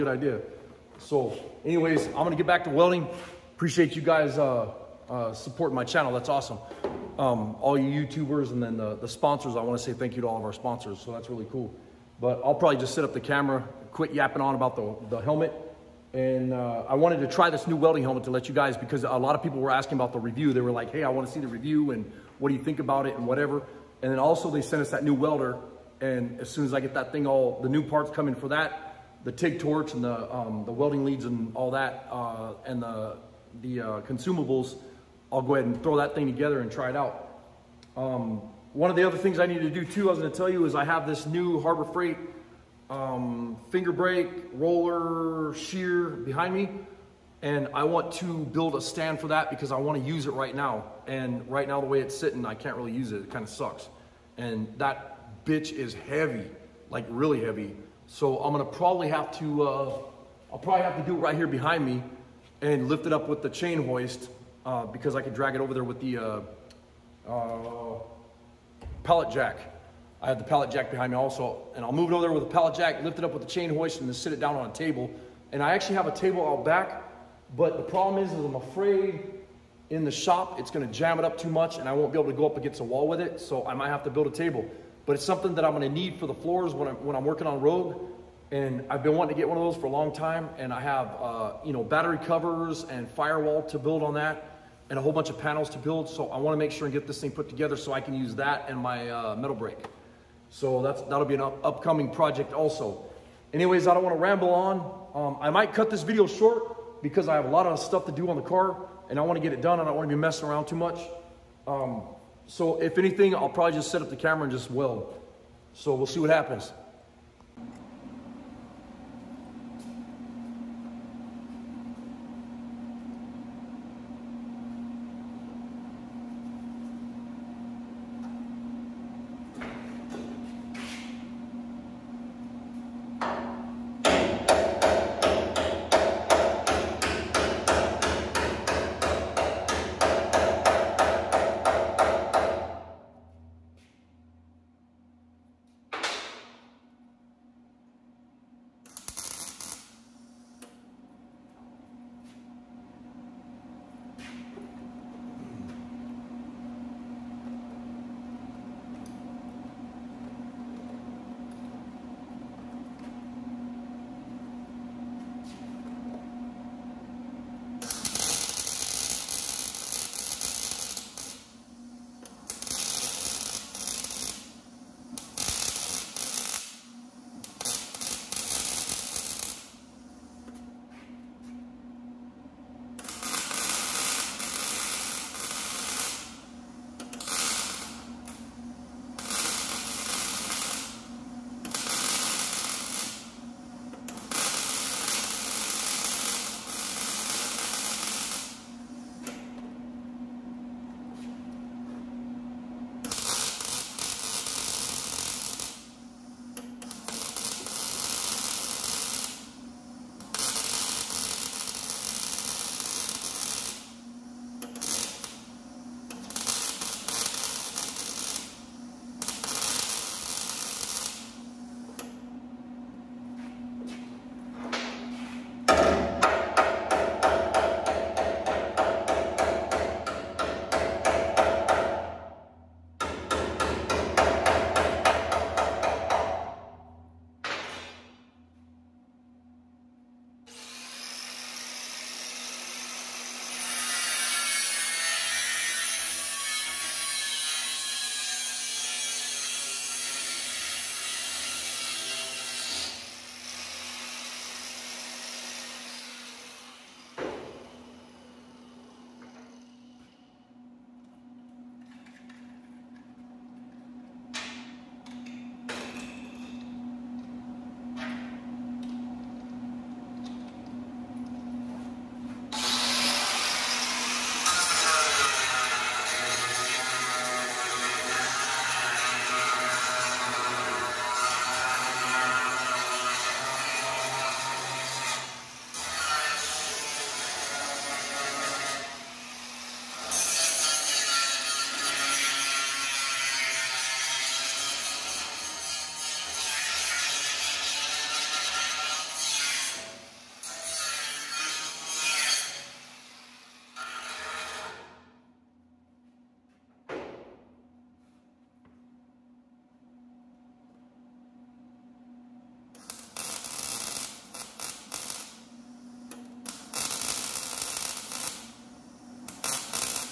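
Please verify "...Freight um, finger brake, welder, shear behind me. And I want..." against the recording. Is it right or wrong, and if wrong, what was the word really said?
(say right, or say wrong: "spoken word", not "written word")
wrong: "roller", not "welder".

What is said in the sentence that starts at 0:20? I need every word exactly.
They were like, hey, I want to see the review and what do you think about it and whatever.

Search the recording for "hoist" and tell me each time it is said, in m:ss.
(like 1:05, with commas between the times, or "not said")
1:03, 1:13.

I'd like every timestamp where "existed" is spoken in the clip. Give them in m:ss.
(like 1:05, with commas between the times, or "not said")
not said.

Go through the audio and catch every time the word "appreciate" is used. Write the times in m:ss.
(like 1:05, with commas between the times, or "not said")
0:03.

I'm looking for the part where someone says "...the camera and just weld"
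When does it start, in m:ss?
1:54.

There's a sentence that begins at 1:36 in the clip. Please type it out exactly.
So I wanna make sure and get this thing put together so I can use that and my uh, metal brake.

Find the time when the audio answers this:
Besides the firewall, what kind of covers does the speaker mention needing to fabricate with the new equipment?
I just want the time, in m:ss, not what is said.
1:31.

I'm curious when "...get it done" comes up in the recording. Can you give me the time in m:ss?
1:49.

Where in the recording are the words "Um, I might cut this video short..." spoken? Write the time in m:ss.
1:45.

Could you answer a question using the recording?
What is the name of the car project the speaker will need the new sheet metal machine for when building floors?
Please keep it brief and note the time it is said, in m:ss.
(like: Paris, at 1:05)
Rogue, at 1:27.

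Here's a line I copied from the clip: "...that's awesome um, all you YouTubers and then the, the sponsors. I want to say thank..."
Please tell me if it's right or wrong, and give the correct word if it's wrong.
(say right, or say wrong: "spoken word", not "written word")
right.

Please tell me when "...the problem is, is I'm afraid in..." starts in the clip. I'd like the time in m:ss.
1:17.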